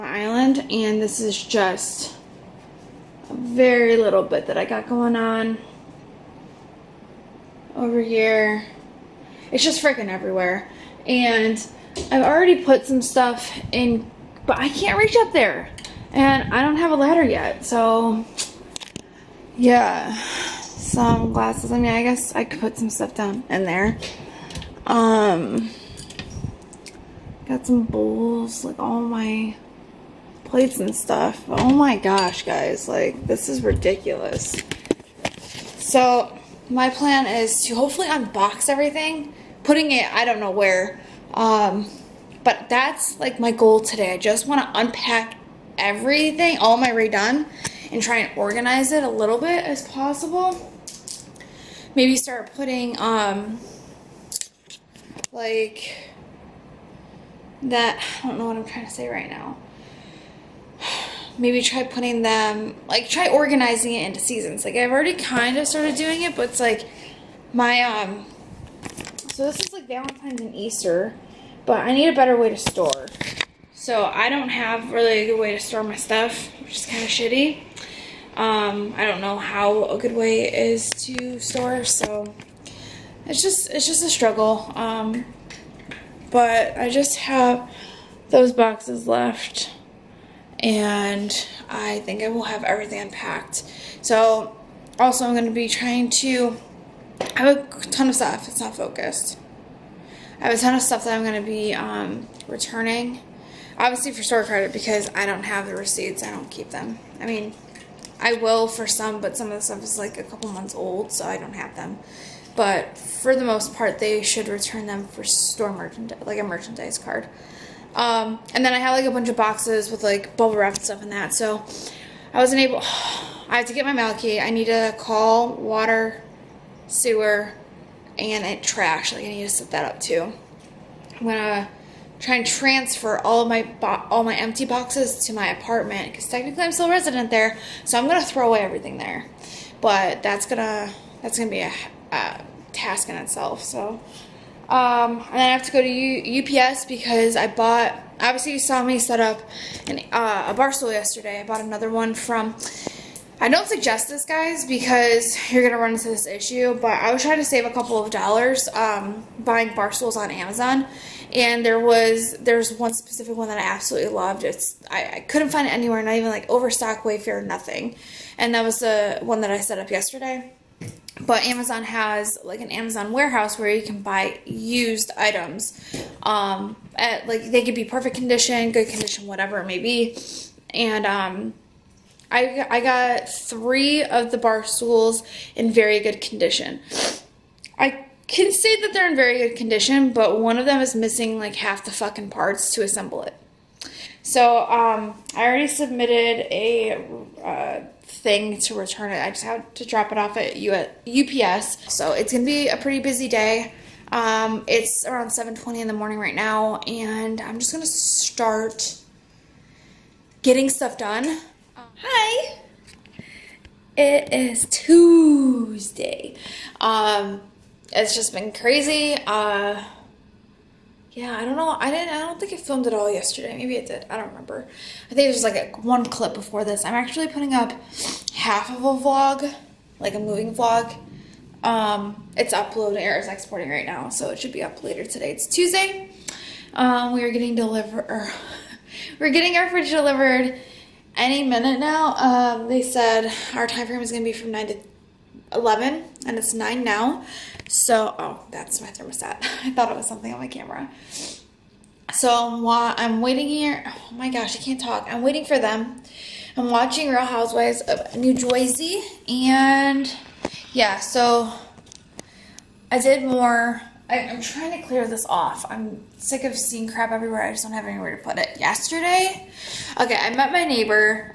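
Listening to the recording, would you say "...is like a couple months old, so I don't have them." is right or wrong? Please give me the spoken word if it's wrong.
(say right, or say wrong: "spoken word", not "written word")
right.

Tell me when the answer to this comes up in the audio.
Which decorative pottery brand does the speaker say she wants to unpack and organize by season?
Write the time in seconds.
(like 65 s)
46 s.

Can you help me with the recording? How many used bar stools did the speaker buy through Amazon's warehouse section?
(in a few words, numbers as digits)
3.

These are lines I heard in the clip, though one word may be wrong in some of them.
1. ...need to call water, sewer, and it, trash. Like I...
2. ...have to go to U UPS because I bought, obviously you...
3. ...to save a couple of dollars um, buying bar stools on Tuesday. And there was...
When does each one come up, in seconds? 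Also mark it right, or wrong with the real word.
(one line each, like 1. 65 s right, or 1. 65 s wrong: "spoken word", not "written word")
1. 124 s right
2. 145 s right
3. 157 s wrong: "Amazon", not "Tuesday".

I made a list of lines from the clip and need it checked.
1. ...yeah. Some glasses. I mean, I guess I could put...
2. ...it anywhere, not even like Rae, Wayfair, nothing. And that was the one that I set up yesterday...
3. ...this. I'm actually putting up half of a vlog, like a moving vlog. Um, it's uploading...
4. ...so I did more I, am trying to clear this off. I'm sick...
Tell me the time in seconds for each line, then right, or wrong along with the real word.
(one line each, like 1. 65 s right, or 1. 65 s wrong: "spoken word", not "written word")
1. 19 s right
2. 165 s wrong: "Overstock", not "Rae"
3. 226 s right
4. 260 s right.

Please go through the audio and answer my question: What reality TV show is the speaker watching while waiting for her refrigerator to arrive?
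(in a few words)
Real Housewives of New Jersey.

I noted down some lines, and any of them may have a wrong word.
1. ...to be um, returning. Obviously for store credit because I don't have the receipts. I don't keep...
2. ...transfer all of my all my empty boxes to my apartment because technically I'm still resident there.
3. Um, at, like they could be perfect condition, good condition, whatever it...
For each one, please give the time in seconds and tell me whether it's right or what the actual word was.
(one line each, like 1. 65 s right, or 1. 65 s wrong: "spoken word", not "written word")
1. 101 s right
2. 132 s right
3. 176 s right.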